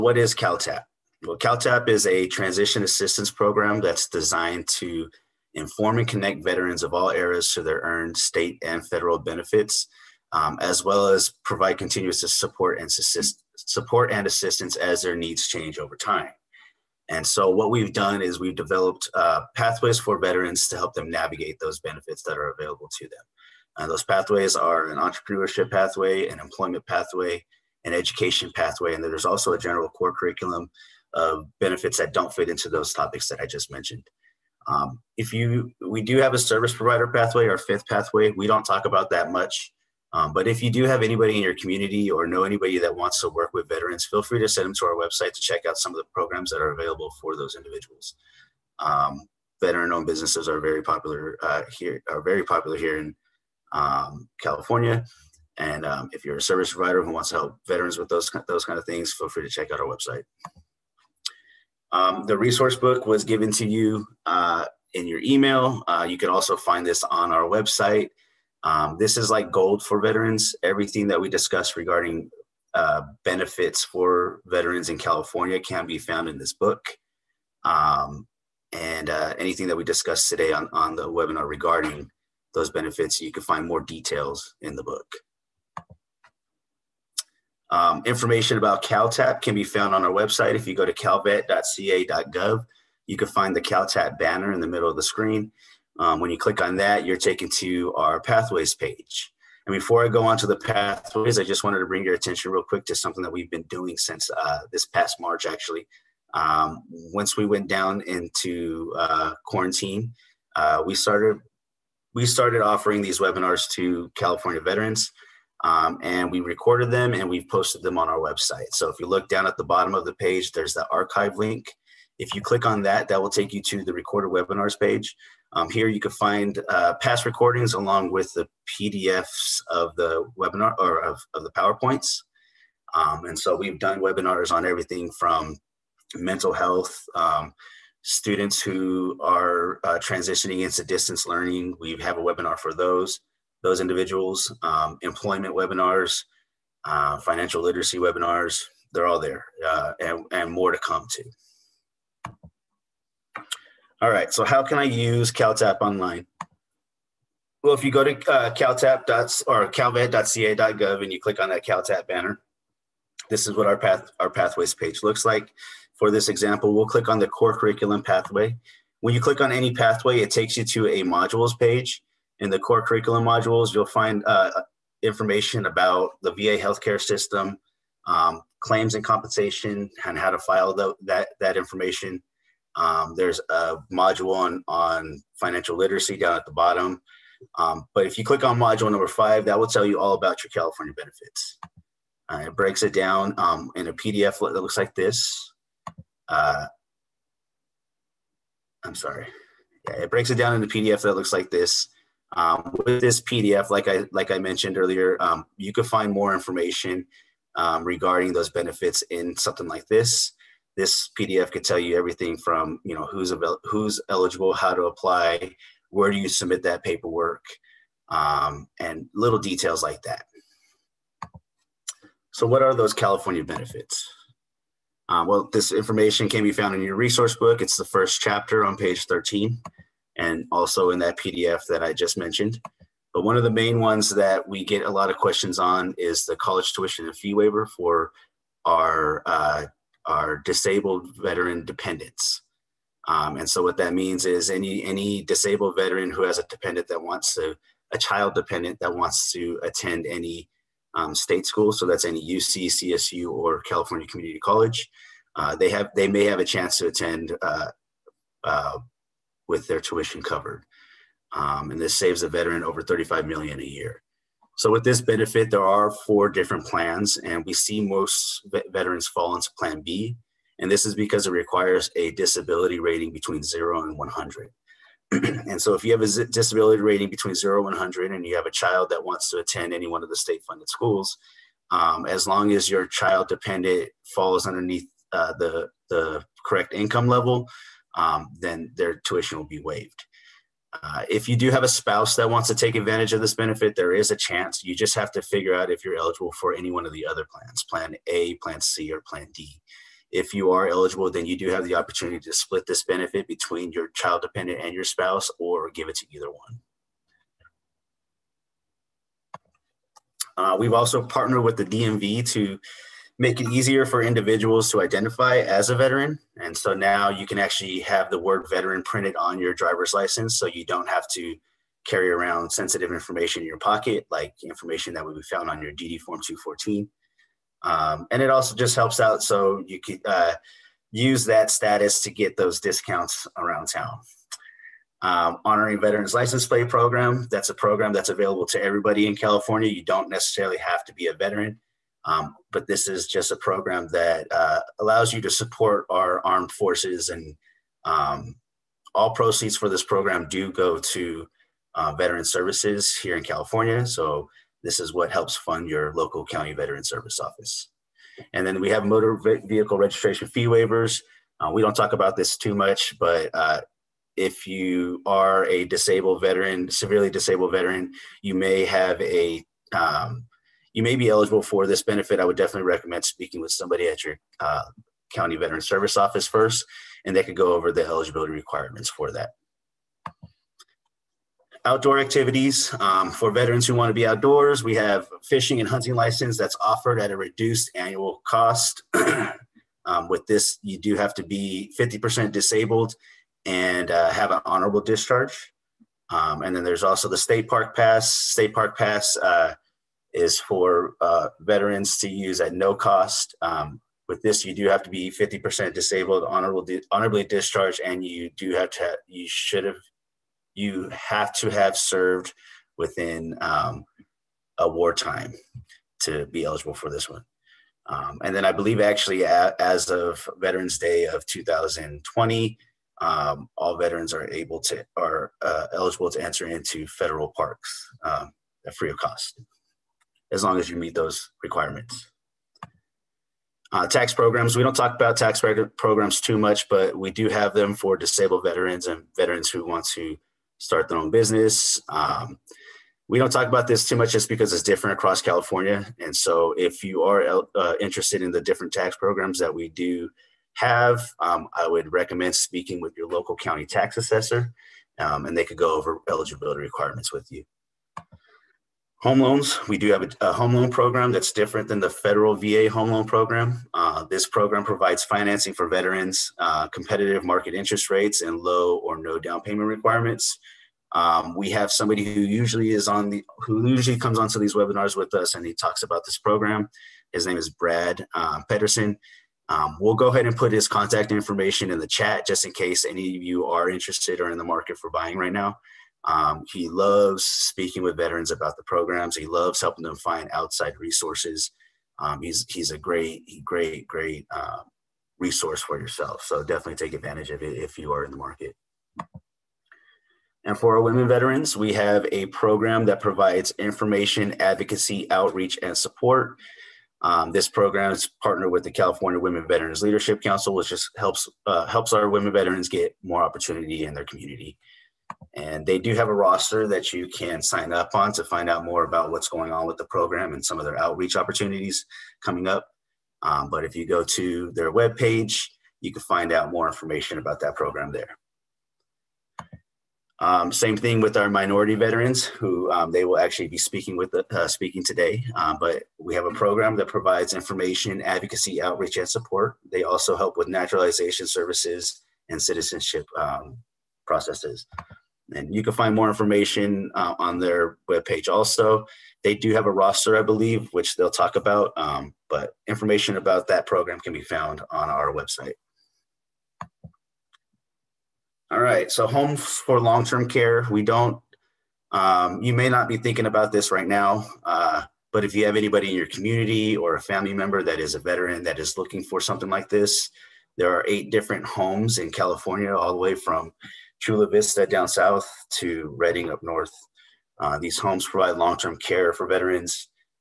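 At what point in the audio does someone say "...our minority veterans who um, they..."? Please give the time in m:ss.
8:51.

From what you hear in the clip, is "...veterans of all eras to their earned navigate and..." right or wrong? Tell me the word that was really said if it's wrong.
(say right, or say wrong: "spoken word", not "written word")
wrong: "state", not "navigate".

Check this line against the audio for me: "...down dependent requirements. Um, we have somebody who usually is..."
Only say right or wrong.
wrong.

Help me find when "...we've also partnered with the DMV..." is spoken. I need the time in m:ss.
5:10.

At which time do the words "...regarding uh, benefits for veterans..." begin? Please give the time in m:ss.
1:11.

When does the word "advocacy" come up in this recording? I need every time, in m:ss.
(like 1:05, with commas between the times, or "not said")
8:24, 8:58.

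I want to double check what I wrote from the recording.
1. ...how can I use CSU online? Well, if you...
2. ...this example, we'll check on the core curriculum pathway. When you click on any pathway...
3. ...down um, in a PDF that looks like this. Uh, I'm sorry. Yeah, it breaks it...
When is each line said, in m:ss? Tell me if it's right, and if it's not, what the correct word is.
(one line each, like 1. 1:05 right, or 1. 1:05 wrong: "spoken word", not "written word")
1. 2:34 wrong: "CalTap", not "CSU"
2. 2:46 wrong: "click", not "check"
3. 3:12 right.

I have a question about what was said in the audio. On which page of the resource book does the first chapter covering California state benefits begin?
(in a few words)
13.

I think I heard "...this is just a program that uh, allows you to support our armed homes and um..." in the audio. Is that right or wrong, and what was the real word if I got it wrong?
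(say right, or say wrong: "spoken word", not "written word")
wrong: "forces", not "homes".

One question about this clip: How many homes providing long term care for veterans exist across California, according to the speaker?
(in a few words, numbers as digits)
8.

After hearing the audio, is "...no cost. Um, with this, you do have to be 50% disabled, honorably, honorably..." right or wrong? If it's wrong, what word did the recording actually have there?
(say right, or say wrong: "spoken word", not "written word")
right.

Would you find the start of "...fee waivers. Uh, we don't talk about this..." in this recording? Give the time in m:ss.
6:00.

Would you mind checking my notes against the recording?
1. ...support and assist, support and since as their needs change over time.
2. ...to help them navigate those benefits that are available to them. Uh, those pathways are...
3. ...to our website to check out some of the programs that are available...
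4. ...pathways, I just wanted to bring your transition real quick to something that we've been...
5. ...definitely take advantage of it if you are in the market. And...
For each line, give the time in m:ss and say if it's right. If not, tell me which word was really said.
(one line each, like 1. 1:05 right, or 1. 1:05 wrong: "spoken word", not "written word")
1. 0:12 wrong: "assistance", not "since"
2. 0:20 right
3. 0:44 right
4. 1:40 wrong: "attention", not "transition"
5. 8:16 right.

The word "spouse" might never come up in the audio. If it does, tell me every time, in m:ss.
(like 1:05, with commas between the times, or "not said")
4:51, 5:04.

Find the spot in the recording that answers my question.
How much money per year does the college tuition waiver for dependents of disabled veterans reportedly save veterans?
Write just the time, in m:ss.
4:22.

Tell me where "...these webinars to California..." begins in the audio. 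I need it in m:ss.
1:53.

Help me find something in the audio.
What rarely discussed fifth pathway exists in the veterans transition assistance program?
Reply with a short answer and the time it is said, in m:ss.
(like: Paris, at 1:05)
service provider pathway, at 0:36.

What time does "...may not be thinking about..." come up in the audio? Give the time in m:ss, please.
9:22.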